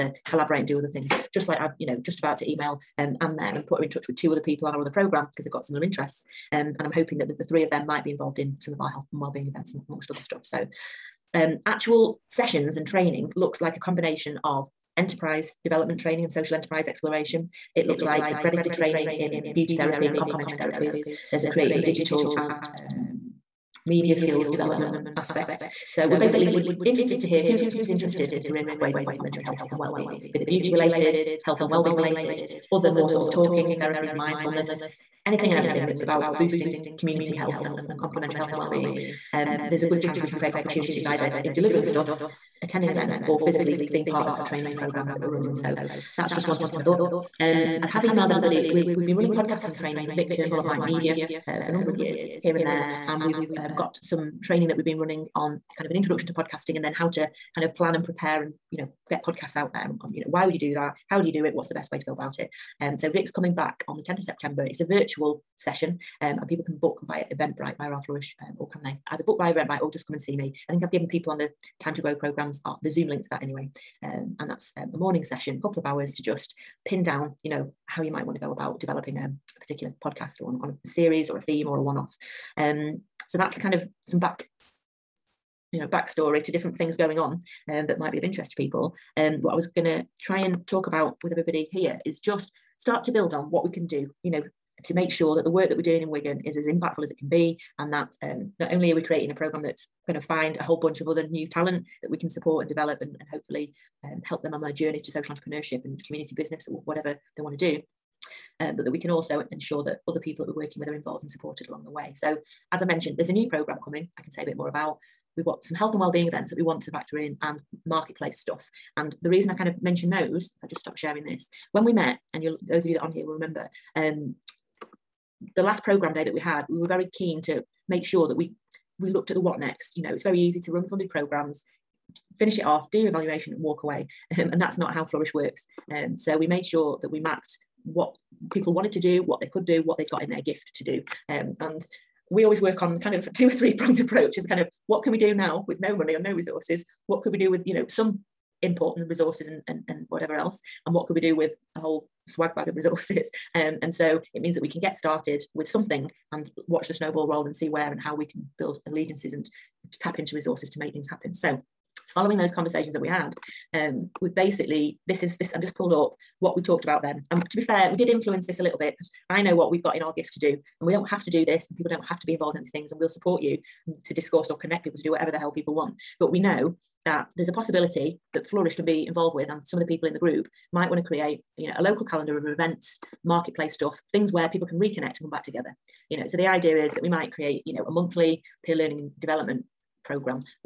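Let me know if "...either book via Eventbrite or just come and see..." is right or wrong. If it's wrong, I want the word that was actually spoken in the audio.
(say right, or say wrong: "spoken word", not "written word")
right.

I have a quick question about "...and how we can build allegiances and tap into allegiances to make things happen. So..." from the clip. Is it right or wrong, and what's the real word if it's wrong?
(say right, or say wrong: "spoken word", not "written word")
wrong: "resources", not "allegiances".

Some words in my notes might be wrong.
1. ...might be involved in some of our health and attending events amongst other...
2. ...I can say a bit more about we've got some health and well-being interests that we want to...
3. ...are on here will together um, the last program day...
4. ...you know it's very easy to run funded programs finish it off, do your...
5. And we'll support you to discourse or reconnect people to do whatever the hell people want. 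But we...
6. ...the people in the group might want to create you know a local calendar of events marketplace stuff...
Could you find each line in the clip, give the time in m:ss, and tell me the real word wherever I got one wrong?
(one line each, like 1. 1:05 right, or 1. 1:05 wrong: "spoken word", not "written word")
1. 0:07 wrong: "wellbeing", not "attending"
2. 1:54 wrong: "events", not "interests"
3. 2:03 wrong: "remember", not "together"
4. 2:09 right
5. 2:52 wrong: "connect", not "reconnect"
6. 2:59 right.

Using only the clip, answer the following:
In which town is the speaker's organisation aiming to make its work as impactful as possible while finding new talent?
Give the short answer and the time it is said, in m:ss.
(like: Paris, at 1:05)
Wigan, at 1:36.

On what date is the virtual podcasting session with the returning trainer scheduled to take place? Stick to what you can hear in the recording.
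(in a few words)
10th of September.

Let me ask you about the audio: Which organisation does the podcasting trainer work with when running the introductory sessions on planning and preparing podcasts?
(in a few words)
Mind Media.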